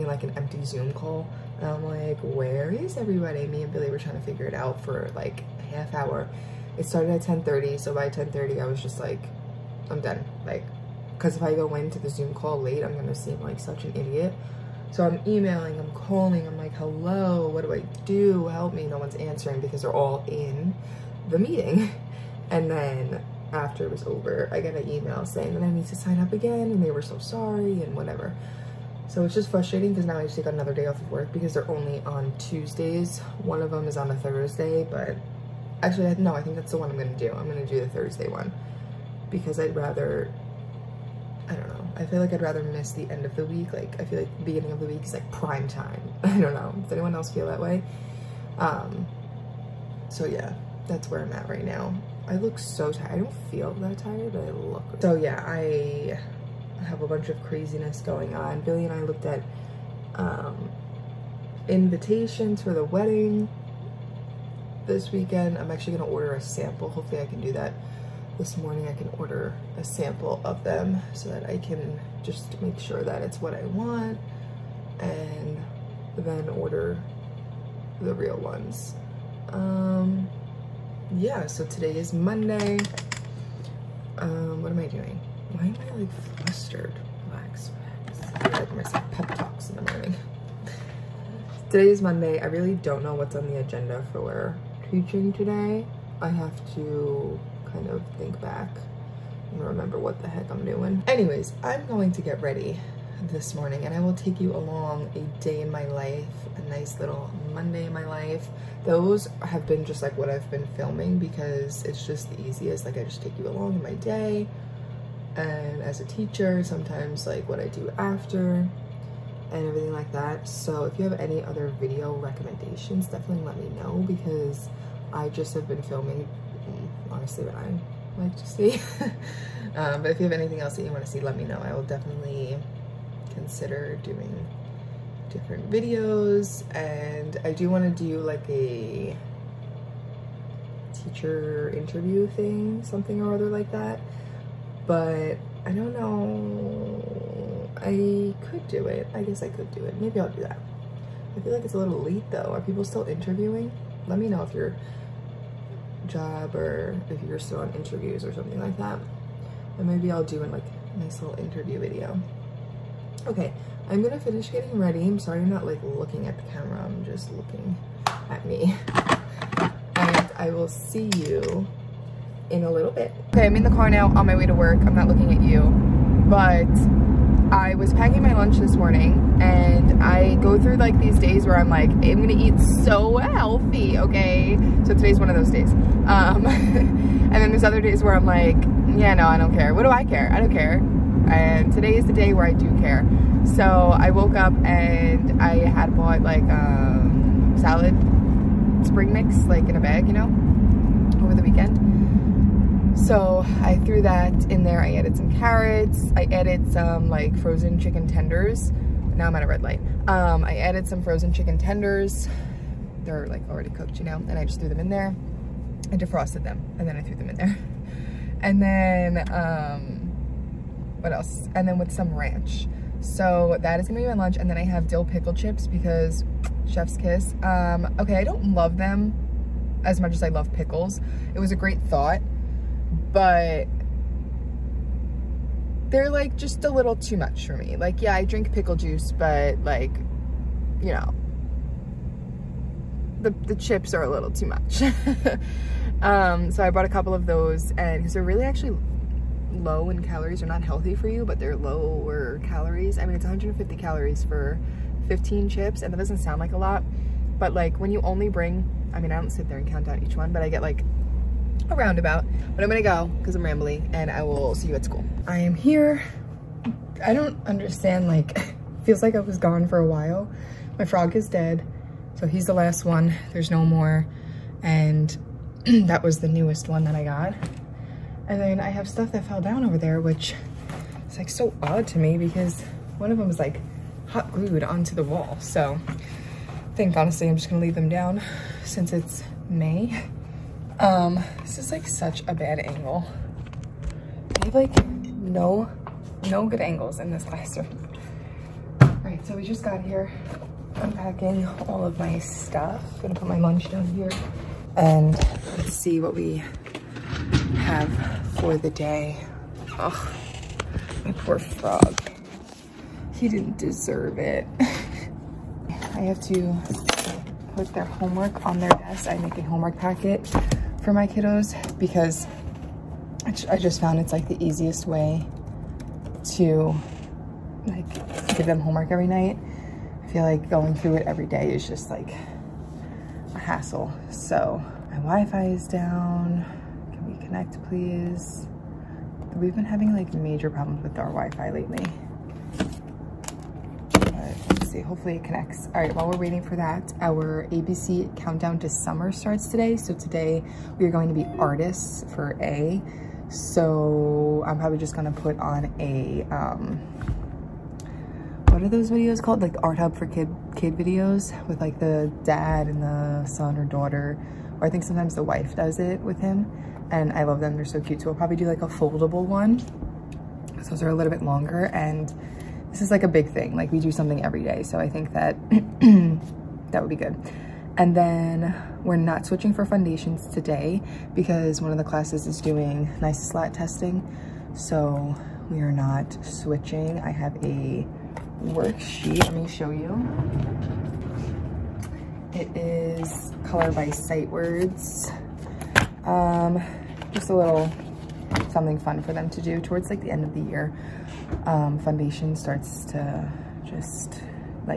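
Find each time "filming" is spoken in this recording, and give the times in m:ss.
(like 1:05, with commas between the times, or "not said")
1:50, 2:05.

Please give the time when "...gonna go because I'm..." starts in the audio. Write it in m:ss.
4:22.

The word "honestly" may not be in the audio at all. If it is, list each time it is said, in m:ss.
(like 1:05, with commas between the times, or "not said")
2:07, 4:46.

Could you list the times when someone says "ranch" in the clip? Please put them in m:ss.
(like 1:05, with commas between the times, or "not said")
3:42.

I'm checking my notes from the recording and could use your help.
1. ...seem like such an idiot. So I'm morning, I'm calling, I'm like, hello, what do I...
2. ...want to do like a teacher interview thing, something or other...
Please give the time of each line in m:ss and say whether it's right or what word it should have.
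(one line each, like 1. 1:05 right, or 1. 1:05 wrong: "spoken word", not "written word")
1. 0:13 wrong: "emailing", not "morning"
2. 2:17 right.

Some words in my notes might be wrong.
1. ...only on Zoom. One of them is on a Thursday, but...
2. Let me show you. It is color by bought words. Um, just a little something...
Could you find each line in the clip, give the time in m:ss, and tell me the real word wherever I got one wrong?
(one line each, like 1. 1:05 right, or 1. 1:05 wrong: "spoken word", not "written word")
1. 0:31 wrong: "Tuesdays", not "Zoom"
2. 6:29 wrong: "sight", not "bought".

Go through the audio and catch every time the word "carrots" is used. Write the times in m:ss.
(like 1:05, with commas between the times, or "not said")
3:25.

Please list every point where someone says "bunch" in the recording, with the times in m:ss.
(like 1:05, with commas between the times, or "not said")
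0:57.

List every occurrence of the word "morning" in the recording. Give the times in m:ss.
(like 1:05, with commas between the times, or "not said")
1:08, 1:29, 1:43, 2:58.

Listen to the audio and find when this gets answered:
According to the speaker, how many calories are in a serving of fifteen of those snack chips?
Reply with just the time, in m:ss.
4:13.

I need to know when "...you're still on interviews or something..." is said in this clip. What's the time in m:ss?
2:37.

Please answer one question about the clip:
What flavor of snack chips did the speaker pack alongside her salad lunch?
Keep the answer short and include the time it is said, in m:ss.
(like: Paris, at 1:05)
dill pickle, at 3:44.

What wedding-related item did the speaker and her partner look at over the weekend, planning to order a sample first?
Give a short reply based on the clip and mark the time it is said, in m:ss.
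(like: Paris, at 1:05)
invitations, at 1:01.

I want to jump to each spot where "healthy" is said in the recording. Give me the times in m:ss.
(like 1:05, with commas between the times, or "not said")
3:03, 4:10.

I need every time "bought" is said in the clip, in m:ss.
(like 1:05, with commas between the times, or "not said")
3:15, 4:06.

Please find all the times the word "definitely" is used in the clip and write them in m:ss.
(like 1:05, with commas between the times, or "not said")
2:03, 2:11.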